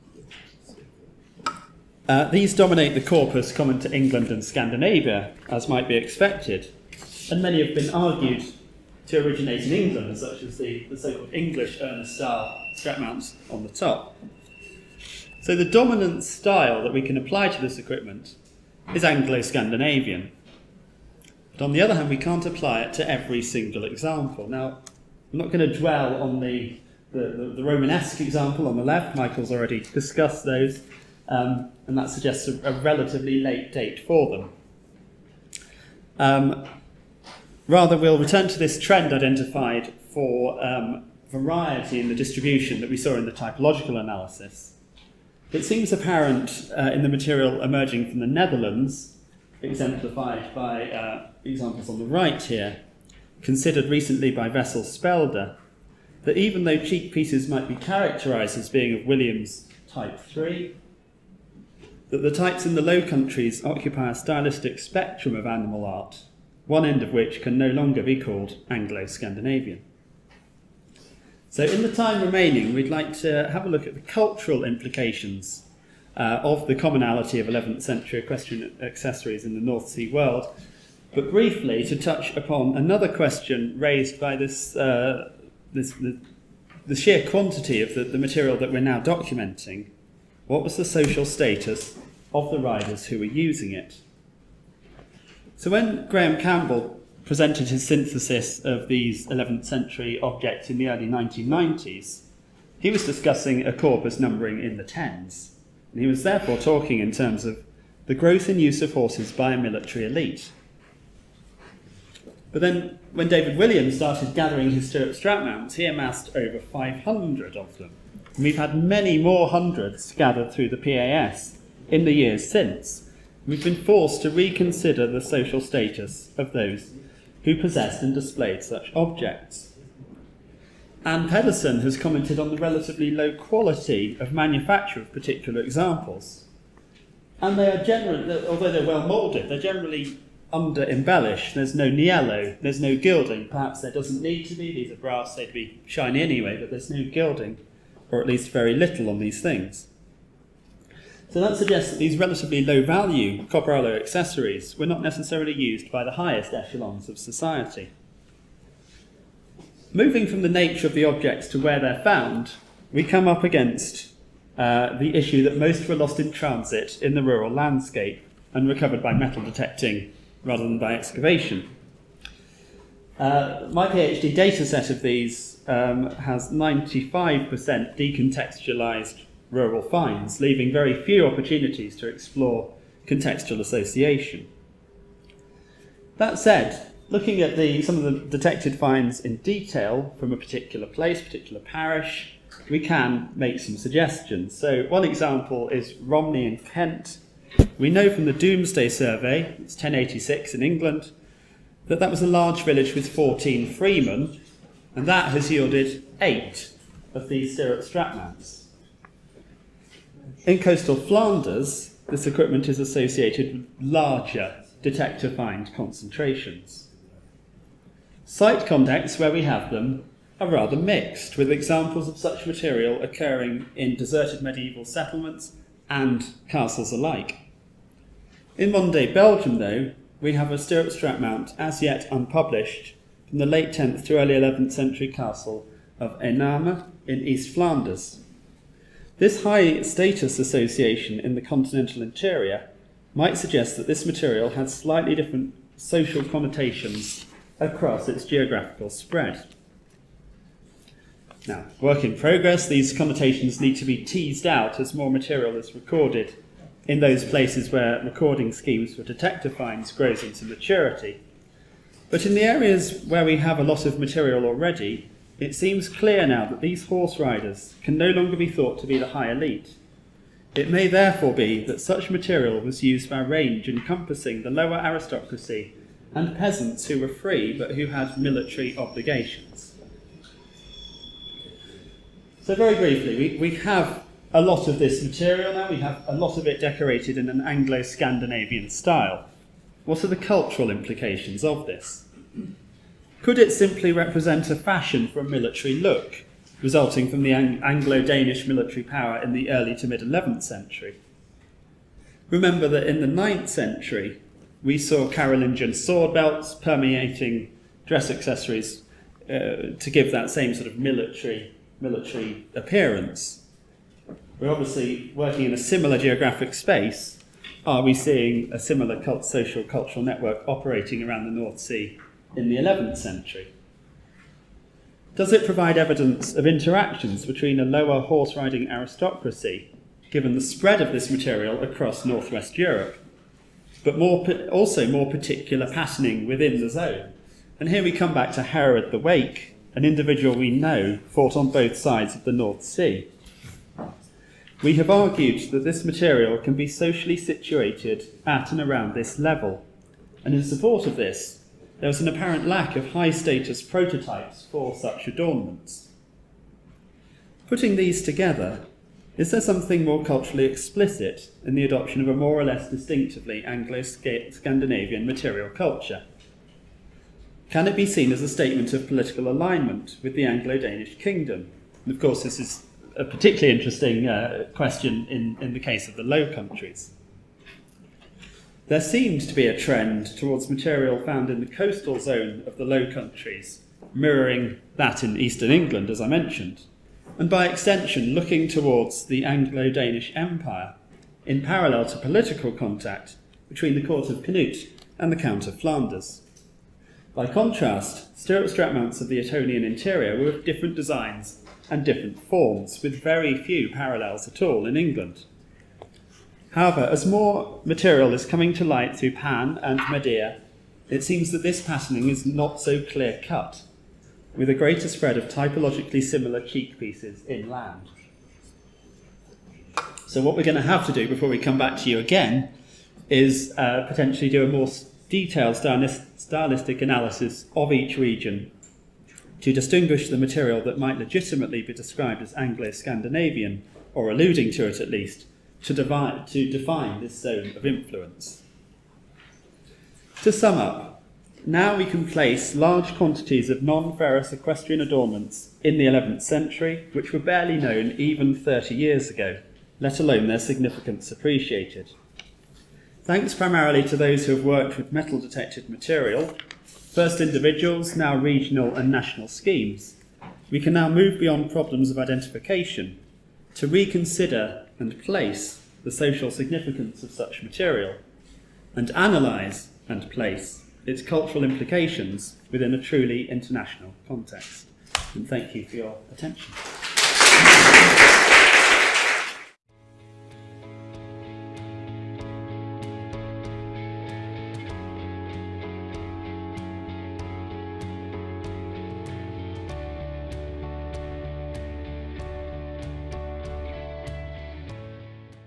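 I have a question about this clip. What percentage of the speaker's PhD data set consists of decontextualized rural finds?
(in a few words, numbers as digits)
95%.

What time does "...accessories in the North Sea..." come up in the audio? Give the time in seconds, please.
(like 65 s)
78 s.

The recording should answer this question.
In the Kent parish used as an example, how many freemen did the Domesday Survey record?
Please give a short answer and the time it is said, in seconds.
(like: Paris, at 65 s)
14, at 203 s.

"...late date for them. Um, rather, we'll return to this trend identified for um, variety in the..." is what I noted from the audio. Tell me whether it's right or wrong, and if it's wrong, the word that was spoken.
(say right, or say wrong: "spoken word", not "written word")
right.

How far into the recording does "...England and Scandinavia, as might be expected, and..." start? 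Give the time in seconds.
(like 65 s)
3 s.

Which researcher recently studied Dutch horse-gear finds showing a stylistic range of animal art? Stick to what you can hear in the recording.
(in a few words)
Vessel Spelder.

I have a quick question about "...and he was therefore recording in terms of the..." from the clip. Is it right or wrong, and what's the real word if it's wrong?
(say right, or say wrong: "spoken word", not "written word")
wrong: "talking", not "recording".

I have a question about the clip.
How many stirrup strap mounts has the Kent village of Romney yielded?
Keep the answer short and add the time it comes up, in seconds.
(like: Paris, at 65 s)
8, at 206 s.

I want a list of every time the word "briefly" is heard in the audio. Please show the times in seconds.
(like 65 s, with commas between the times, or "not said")
81 s, 282 s.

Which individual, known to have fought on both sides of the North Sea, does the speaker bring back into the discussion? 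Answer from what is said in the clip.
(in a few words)
Hereward the Wake.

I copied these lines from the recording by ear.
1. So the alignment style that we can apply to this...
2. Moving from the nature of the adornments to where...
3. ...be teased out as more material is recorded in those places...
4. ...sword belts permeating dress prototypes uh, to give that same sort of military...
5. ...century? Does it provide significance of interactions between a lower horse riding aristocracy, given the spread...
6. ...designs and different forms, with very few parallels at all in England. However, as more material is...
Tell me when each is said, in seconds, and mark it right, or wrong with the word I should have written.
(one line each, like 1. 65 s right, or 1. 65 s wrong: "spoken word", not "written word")
1. 15 s wrong: "dominant", not "alignment"
2. 159 s wrong: "objects", not "adornments"
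3. 253 s right
4. 305 s wrong: "accessories", not "prototypes"
5. 322 s wrong: "evidence", not "significance"
6. 400 s right.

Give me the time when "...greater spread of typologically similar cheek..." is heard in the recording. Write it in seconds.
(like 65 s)
414 s.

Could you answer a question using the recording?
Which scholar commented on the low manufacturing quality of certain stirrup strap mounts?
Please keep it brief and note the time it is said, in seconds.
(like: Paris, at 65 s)
Anne Pedersen, at 131 s.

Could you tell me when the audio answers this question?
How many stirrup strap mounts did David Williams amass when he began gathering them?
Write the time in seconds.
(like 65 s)
116 s.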